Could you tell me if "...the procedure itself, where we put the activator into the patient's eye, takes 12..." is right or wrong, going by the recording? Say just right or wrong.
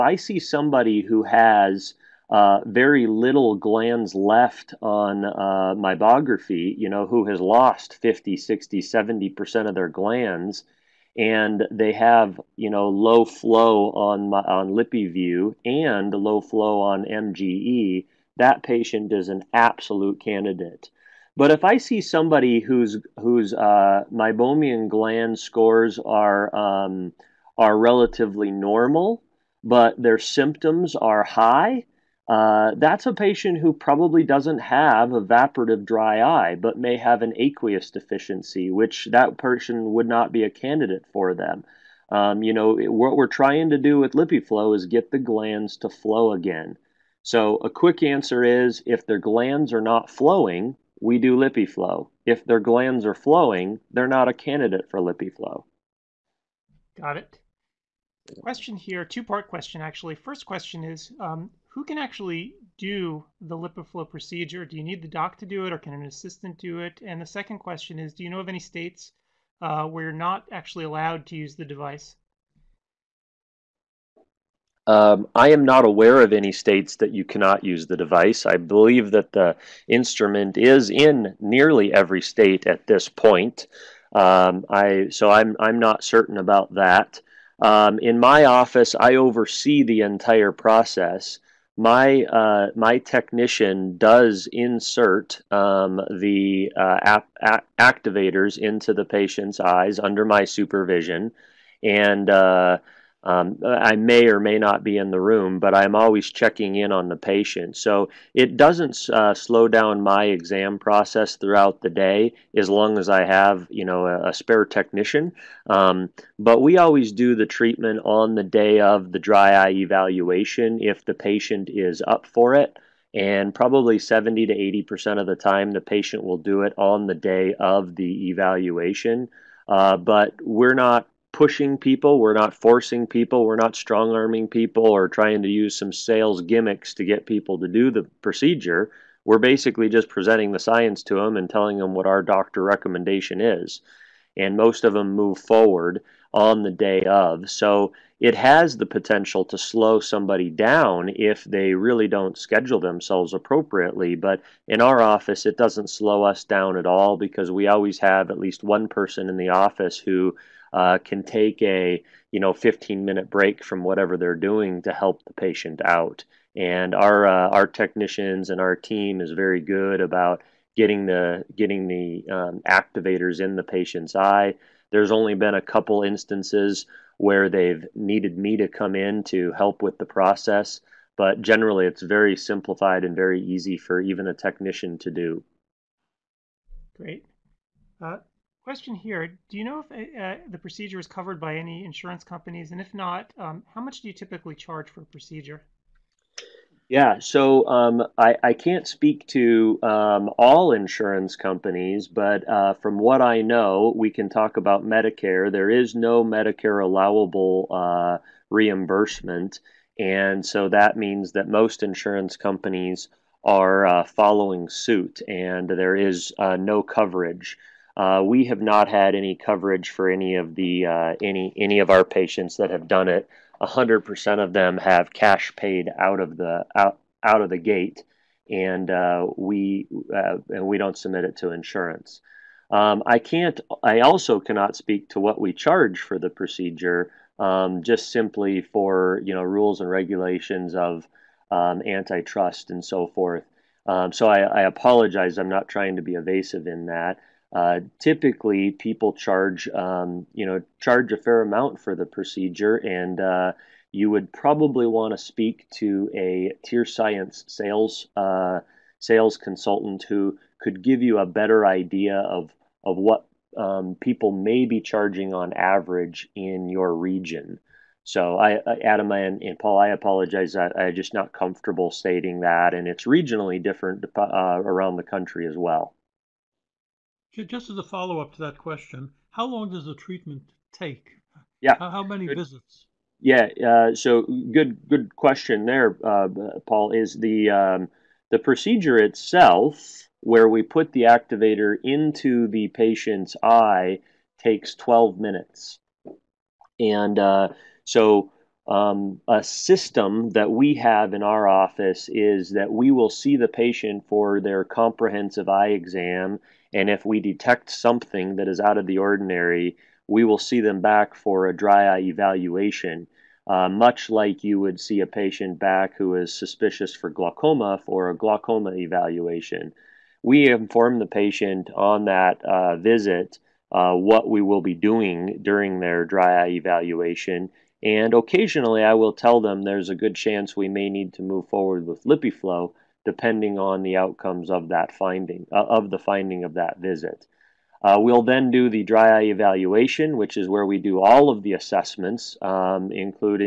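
right.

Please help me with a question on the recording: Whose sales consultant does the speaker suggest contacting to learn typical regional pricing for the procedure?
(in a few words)
TearScience.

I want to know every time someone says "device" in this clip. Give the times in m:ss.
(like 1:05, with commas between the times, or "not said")
1:11, 1:17.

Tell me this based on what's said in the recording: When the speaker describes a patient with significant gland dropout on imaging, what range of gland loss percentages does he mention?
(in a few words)
50, 60, 70%.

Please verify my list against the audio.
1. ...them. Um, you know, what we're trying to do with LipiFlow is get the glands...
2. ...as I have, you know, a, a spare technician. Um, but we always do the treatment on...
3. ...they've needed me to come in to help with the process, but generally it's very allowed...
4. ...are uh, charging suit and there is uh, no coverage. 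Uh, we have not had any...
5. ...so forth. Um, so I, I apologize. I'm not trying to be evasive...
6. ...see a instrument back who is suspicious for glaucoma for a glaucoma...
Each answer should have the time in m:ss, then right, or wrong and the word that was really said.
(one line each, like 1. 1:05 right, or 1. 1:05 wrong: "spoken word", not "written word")
1. 0:41 right
2. 1:52 right
3. 2:57 wrong: "simplified", not "allowed"
4. 3:33 wrong: "following", not "charging"
5. 4:02 right
6. 5:14 wrong: "patient", not "instrument".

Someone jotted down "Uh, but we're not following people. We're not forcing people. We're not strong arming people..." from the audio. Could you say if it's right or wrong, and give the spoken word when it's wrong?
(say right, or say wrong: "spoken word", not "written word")
wrong: "pushing", not "following".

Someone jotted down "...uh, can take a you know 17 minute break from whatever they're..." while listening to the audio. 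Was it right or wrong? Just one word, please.
wrong.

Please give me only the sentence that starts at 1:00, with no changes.
First question is, um, who can actually do the LipiFlow procedure?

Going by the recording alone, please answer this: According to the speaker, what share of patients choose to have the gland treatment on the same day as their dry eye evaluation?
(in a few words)
70 to 80%.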